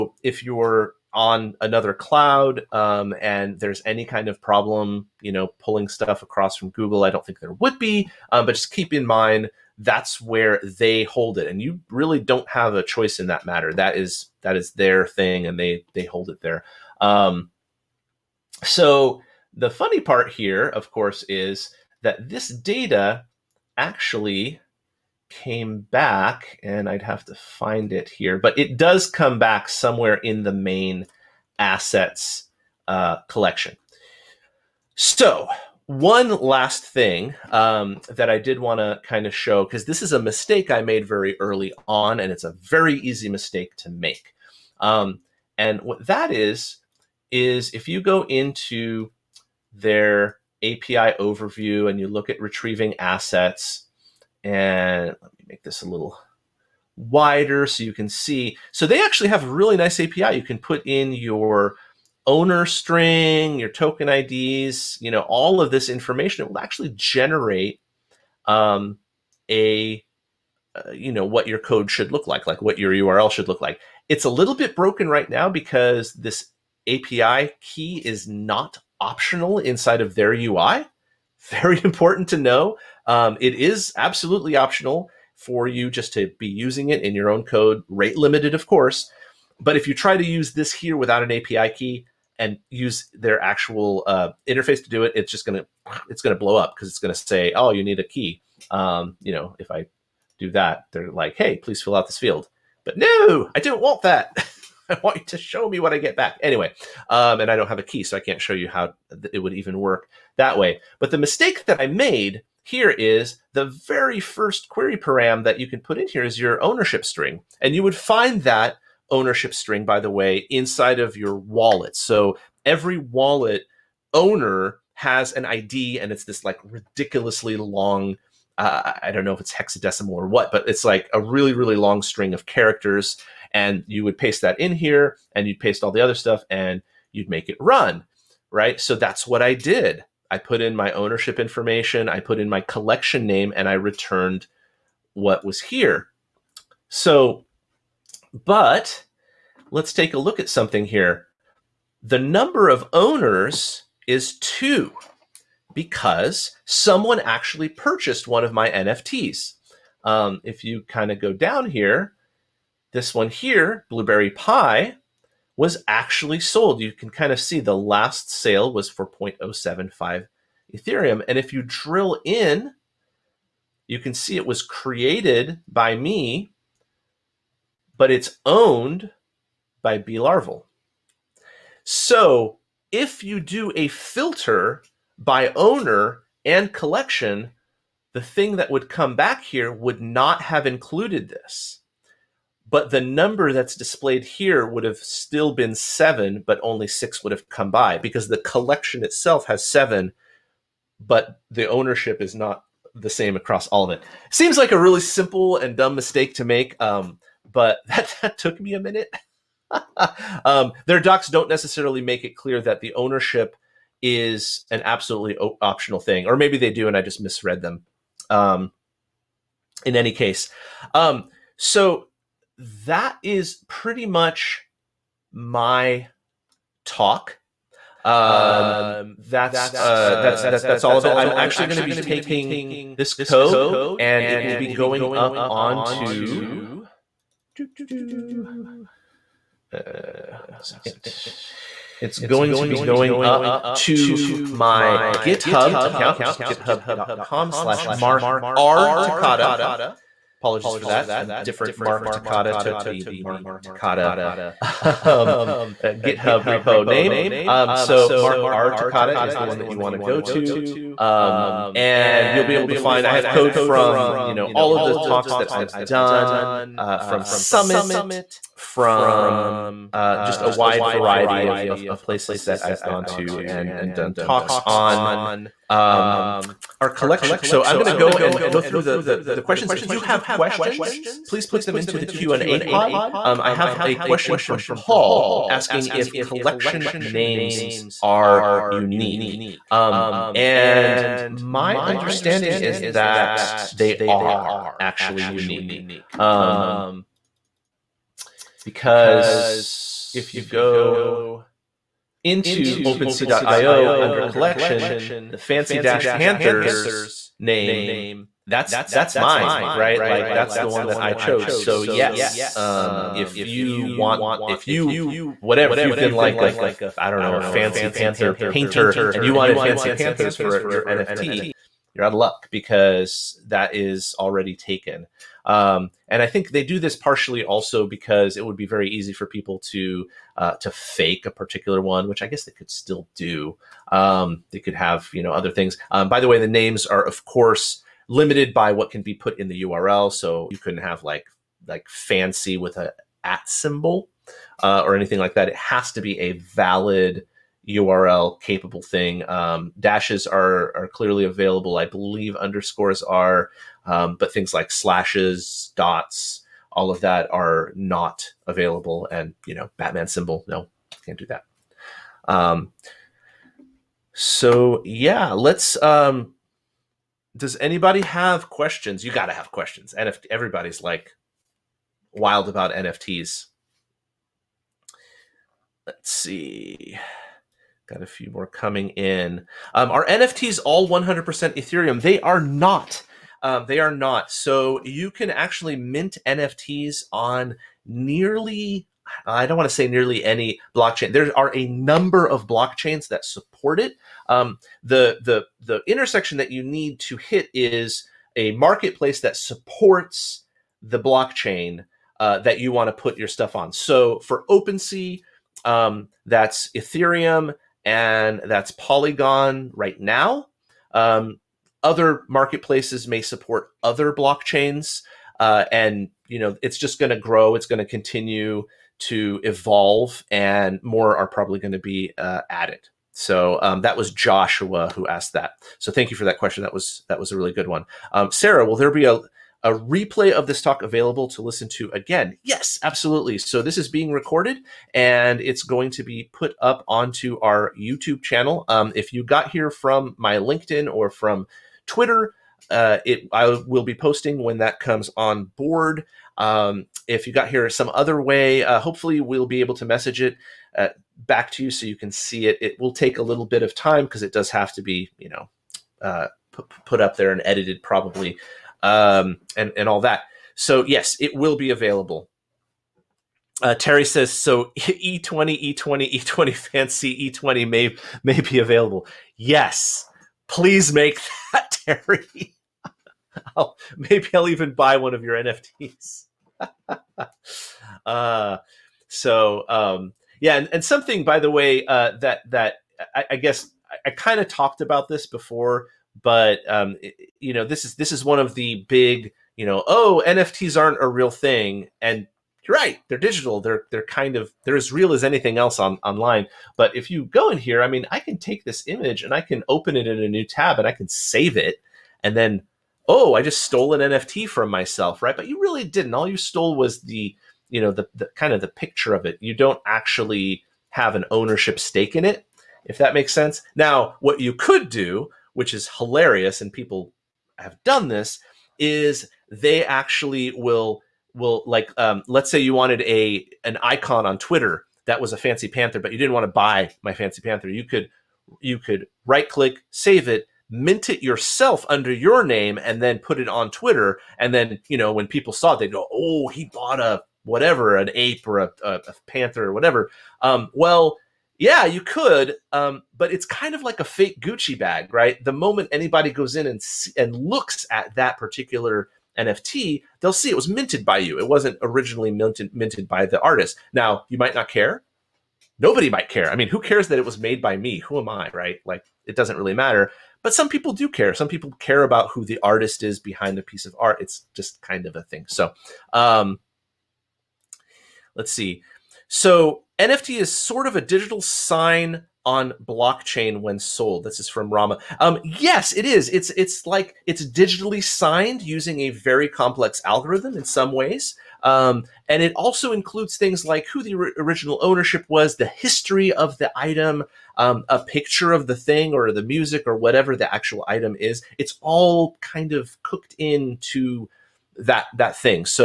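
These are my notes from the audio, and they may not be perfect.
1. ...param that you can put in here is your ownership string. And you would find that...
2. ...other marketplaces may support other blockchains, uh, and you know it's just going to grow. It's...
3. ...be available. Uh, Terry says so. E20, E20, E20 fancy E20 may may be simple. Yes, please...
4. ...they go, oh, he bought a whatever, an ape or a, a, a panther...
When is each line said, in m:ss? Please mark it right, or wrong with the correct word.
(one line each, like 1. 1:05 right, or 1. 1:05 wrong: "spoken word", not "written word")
1. 1:54 right
2. 6:51 right
3. 7:41 wrong: "available", not "simple"
4. 8:55 right.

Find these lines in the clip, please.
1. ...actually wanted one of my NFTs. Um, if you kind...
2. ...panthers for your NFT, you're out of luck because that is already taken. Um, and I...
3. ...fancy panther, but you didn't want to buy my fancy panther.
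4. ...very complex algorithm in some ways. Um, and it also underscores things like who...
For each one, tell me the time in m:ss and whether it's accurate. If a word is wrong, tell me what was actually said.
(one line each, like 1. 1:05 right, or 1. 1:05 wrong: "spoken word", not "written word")
1. 2:37 wrong: "purchased", not "wanted"
2. 5:19 right
3. 8:45 right
4. 9:39 wrong: "includes", not "underscores".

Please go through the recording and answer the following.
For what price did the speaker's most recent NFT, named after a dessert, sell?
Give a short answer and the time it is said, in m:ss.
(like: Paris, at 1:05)
0.075 Ethereum, at 2:49.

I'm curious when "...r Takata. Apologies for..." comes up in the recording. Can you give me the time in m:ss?
4:08.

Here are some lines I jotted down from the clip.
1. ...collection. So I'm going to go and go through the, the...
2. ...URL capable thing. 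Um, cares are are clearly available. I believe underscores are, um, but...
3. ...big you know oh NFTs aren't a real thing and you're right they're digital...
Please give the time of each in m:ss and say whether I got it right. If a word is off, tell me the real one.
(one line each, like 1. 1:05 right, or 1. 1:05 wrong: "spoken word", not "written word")
1. 4:36 right
2. 5:47 wrong: "dashes", not "cares"
3. 8:08 right.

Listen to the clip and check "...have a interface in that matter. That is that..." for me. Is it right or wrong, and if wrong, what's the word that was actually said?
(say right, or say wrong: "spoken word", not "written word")
wrong: "choice", not "interface".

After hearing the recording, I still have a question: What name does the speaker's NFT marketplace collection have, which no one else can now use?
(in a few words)
Fancy Panthers.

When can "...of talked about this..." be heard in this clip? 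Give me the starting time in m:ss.
8:04.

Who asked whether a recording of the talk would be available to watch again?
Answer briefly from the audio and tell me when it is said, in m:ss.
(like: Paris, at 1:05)
Sarah, at 7:08.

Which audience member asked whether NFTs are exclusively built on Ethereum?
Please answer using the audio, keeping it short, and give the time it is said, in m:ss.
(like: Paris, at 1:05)
Joshua, at 7:04.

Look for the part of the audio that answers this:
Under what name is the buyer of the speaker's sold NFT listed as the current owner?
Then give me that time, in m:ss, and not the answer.
2:59.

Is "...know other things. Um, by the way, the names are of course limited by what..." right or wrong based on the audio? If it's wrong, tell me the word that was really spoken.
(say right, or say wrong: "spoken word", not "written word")
right.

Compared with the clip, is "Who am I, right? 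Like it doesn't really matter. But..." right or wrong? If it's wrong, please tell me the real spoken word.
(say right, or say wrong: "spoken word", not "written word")
right.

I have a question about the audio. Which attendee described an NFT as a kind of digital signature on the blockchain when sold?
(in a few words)
Rama.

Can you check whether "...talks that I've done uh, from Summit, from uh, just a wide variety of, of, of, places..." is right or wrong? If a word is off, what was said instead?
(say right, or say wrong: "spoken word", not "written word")
right.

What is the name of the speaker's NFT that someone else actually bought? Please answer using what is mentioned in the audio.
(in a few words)
Blueberry Pie.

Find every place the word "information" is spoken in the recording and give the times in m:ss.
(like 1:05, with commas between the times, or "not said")
1:05, 2:21.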